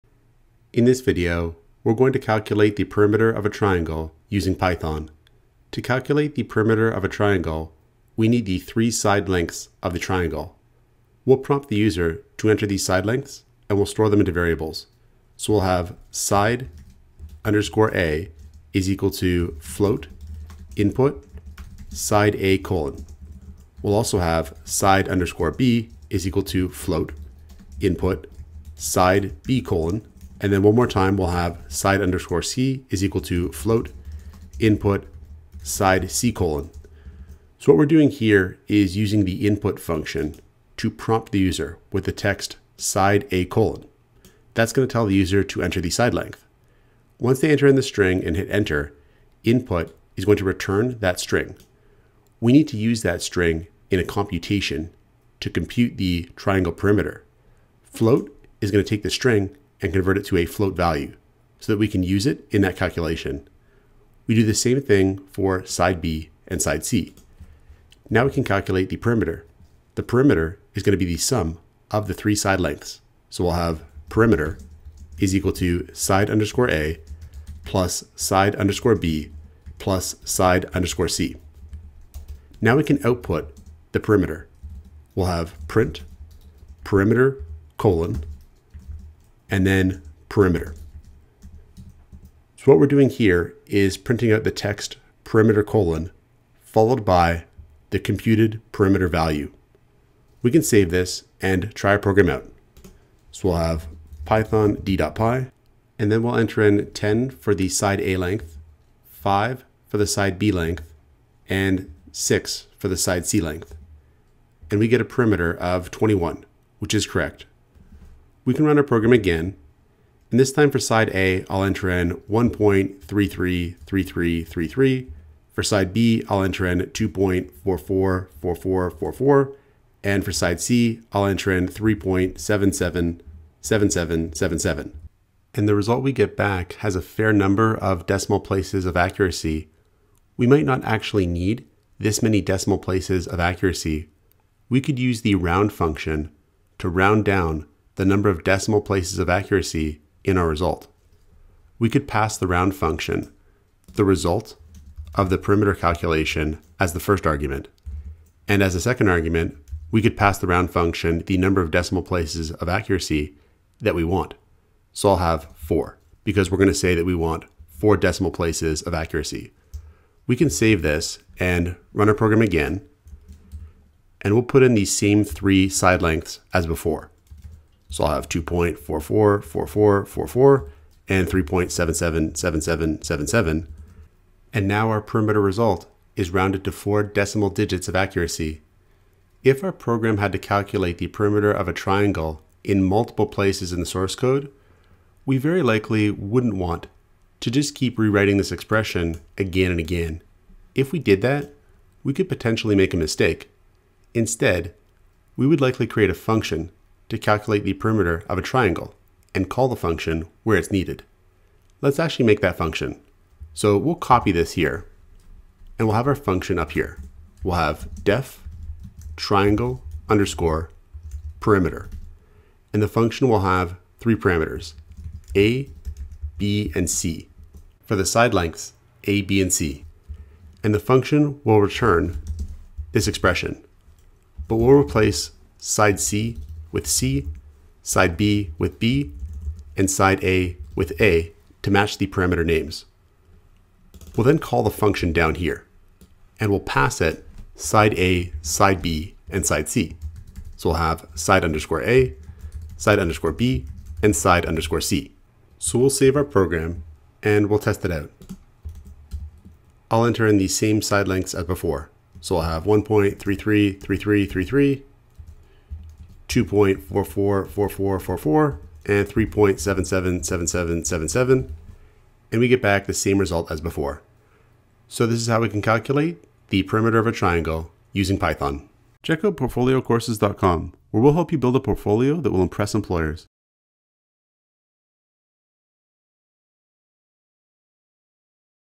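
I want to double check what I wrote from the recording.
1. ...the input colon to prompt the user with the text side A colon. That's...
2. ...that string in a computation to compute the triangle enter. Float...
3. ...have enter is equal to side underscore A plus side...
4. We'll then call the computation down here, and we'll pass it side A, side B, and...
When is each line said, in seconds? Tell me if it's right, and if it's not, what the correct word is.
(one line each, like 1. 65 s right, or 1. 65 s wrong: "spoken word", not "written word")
1. 39 s wrong: "function", not "colon"
2. 53 s wrong: "perimeter", not "enter"
3. 73 s wrong: "perimeter", not "enter"
4. 244 s wrong: "function", not "computation".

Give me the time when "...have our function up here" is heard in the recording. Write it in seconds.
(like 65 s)
215 s.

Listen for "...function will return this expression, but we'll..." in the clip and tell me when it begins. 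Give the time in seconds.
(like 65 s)
230 s.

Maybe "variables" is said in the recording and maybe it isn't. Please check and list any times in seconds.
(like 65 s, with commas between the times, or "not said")
14 s.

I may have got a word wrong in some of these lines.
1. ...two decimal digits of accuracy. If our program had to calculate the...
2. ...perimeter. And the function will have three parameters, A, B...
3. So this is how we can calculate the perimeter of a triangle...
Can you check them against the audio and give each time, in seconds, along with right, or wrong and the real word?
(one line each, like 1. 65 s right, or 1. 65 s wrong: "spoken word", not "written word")
1. 186 s wrong: "four", not "two"
2. 221 s right
3. 274 s right.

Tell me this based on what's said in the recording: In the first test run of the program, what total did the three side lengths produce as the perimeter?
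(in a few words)
21.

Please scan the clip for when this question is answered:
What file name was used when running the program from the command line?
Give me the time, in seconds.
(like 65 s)
104 s.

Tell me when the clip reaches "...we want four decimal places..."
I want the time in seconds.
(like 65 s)
167 s.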